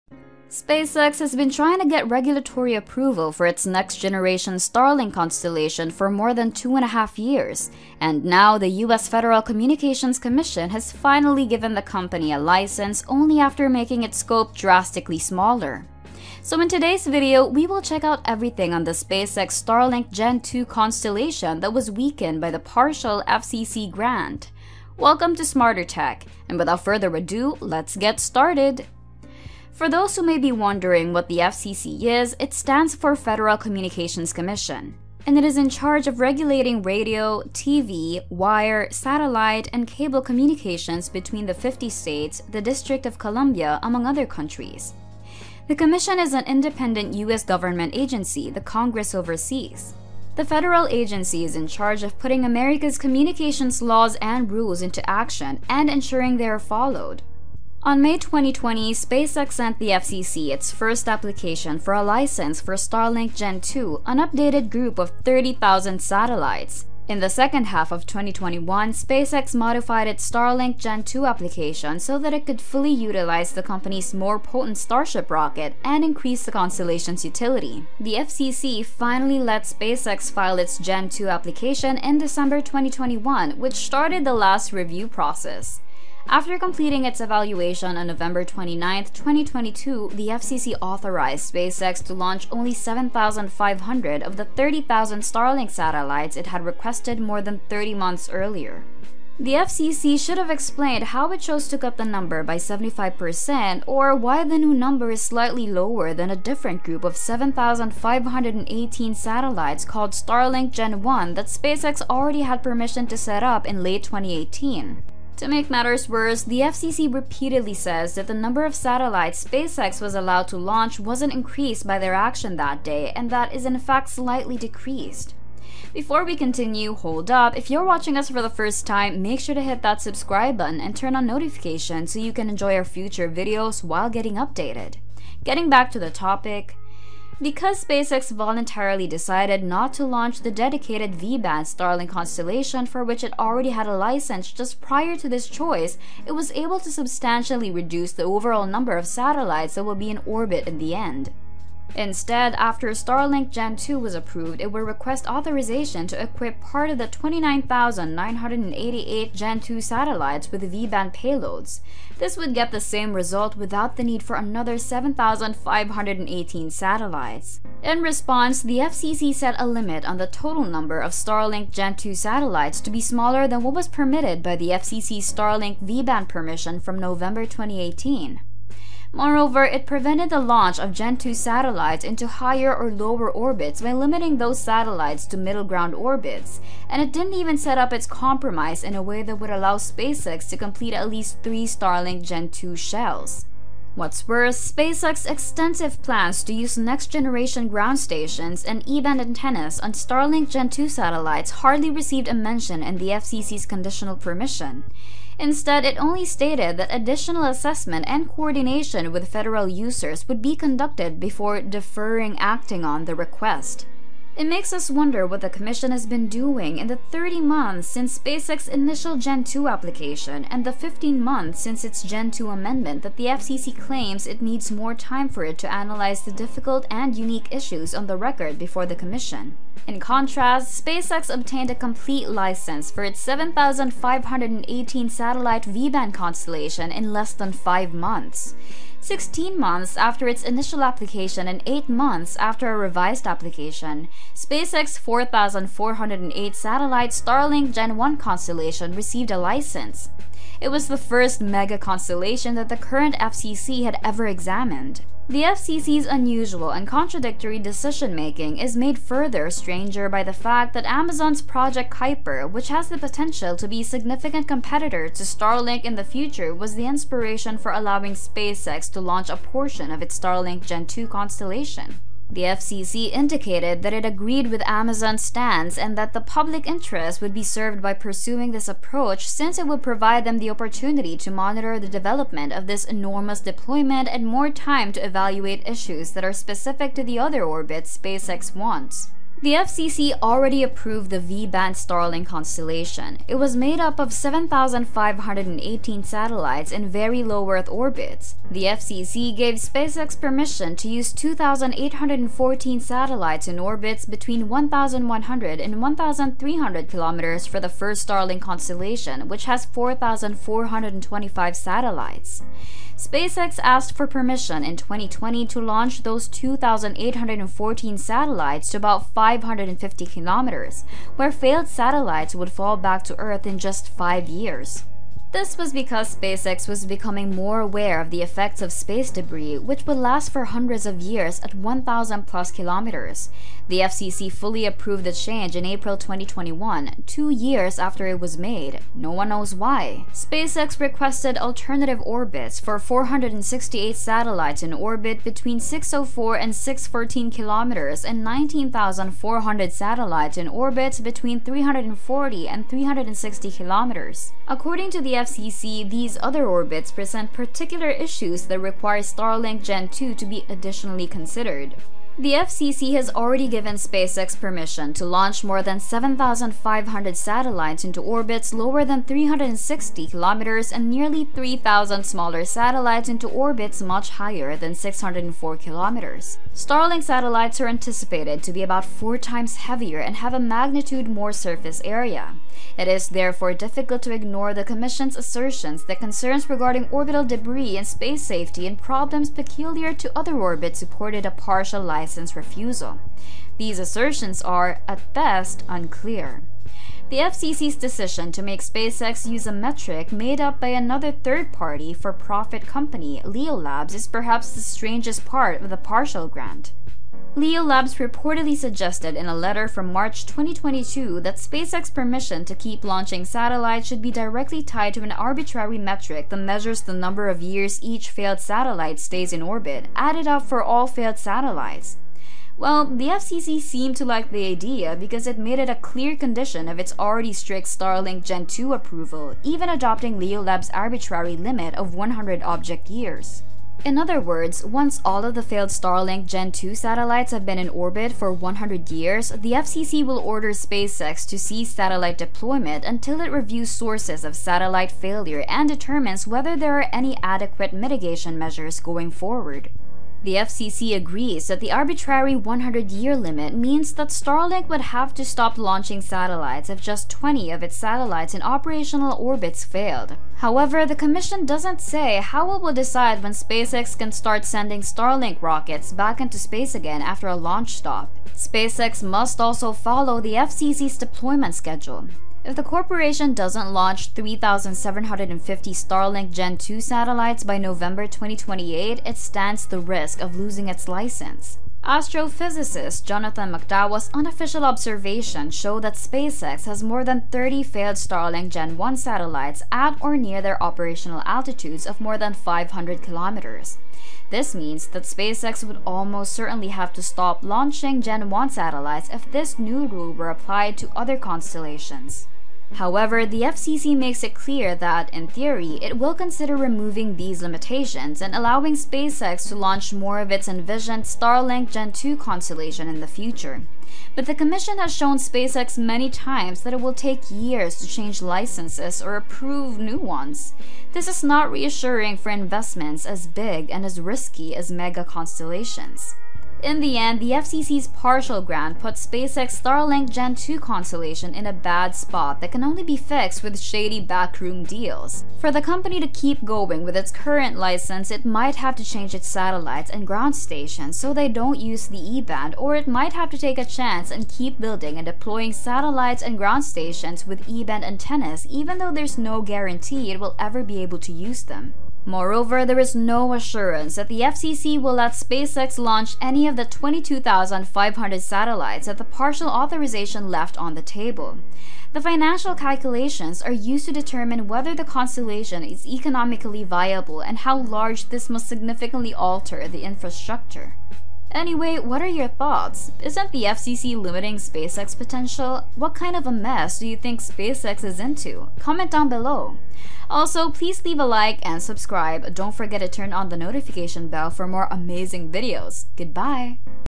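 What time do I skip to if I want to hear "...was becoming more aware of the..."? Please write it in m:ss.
5:26.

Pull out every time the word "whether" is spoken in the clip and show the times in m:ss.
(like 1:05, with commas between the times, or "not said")
7:26, 9:24.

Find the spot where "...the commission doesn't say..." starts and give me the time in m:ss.
7:40.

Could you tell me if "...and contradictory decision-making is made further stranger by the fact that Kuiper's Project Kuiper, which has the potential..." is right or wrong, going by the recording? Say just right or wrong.
wrong.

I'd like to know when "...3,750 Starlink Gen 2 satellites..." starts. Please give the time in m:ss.
7:54.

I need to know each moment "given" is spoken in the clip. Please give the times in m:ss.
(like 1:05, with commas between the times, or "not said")
0:11, 6:03.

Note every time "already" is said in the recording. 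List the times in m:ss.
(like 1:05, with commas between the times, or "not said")
1:52, 2:23, 4:50, 6:03, 7:06.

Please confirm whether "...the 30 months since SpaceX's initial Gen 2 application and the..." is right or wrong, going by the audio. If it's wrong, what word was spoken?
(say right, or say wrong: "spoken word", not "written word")
right.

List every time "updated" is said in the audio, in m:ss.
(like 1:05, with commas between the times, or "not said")
1:04, 2:14.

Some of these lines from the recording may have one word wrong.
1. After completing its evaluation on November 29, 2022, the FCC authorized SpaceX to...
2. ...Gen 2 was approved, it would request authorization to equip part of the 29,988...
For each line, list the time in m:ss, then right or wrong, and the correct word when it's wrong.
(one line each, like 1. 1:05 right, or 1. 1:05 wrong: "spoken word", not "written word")
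1. 1:26 right
2. 2:33 right.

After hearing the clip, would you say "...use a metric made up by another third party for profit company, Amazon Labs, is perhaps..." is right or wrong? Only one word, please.
wrong.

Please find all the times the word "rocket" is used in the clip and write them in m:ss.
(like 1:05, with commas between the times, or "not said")
1:15, 7:45.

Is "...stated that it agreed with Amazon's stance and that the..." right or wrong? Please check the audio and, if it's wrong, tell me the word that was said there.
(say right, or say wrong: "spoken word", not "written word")
wrong: "indicated", not "stated".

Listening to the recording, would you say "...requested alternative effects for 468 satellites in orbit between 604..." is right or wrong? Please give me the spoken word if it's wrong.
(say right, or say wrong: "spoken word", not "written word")
wrong: "orbits", not "effects".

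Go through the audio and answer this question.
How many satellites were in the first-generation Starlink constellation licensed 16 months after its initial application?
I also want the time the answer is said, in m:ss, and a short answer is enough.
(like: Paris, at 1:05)
4408, at 4:04.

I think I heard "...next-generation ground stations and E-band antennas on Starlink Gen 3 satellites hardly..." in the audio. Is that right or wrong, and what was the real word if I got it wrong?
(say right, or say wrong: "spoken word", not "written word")
wrong: "2", not "3".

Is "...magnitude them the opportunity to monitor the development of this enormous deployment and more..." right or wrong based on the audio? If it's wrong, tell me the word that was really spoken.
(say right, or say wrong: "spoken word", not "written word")
wrong: "provide", not "magnitude".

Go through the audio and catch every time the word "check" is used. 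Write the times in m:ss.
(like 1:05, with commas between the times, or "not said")
0:17.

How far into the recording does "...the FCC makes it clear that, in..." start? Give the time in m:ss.
8:23.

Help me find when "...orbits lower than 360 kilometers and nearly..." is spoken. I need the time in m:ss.
6:08.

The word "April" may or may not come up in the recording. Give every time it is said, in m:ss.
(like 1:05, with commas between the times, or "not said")
5:35.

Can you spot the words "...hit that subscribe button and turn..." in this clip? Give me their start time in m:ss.
2:09.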